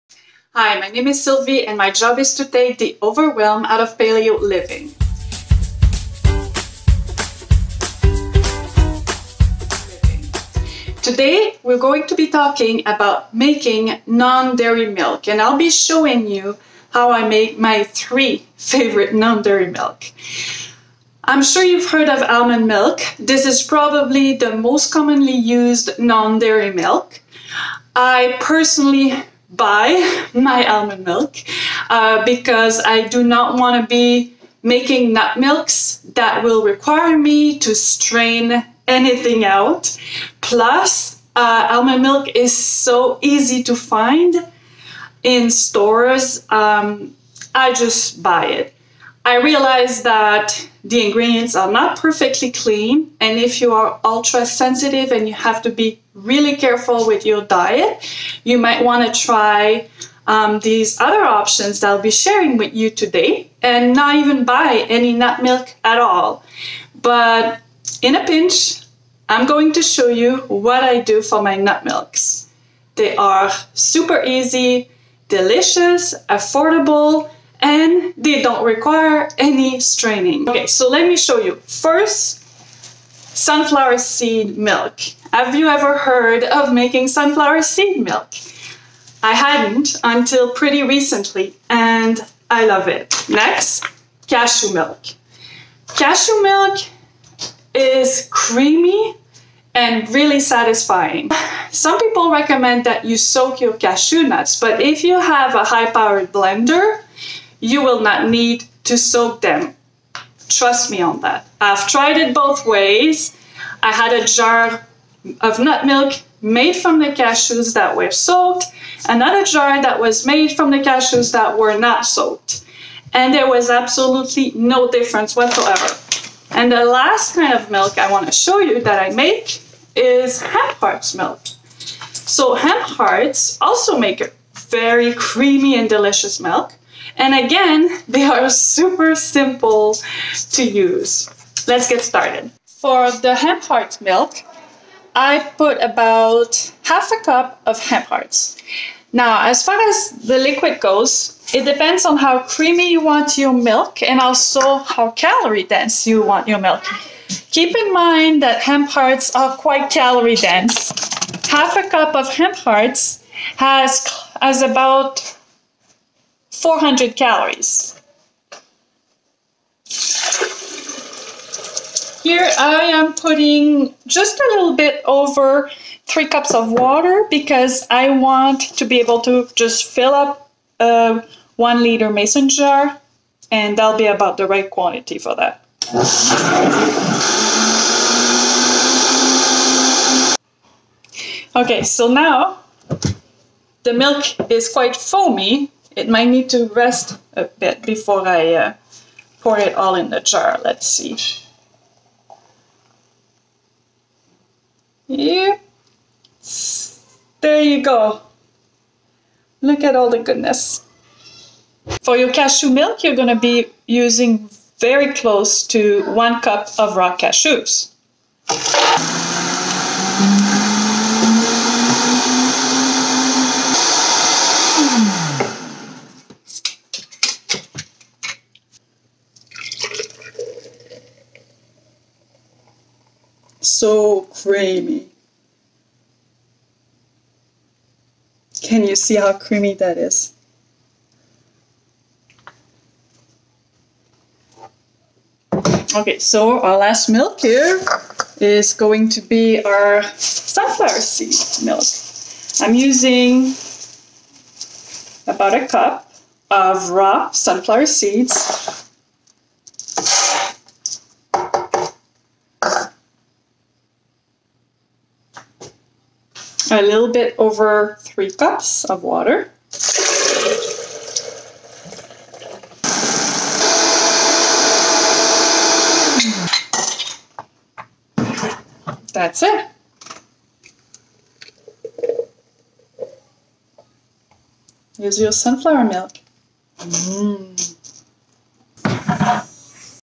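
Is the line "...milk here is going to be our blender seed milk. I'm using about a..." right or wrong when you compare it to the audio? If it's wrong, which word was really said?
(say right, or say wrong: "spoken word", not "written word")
wrong: "sunflower", not "blender".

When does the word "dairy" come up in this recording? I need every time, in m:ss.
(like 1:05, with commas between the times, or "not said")
0:14, 0:19, 0:25.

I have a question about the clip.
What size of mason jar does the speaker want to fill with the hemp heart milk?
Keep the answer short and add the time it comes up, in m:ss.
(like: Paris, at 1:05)
1 liter, at 3:01.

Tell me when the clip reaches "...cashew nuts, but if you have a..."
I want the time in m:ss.
1:43.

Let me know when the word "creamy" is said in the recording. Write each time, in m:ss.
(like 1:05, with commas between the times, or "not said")
1:38, 2:15, 2:32, 3:54, 3:59.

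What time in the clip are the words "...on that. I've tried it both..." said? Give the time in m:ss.
1:51.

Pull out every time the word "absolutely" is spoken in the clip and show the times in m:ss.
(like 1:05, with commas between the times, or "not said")
2:03.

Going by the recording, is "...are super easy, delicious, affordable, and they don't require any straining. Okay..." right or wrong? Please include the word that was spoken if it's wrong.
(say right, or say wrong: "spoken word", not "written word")
right.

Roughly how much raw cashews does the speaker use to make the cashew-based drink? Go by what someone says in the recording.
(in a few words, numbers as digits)
1 cup.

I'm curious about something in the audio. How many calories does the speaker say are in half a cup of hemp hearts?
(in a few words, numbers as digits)
about 400.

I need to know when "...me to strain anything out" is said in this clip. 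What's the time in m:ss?
0:37.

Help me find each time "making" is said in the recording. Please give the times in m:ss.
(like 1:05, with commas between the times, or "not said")
0:13, 0:34, 1:26.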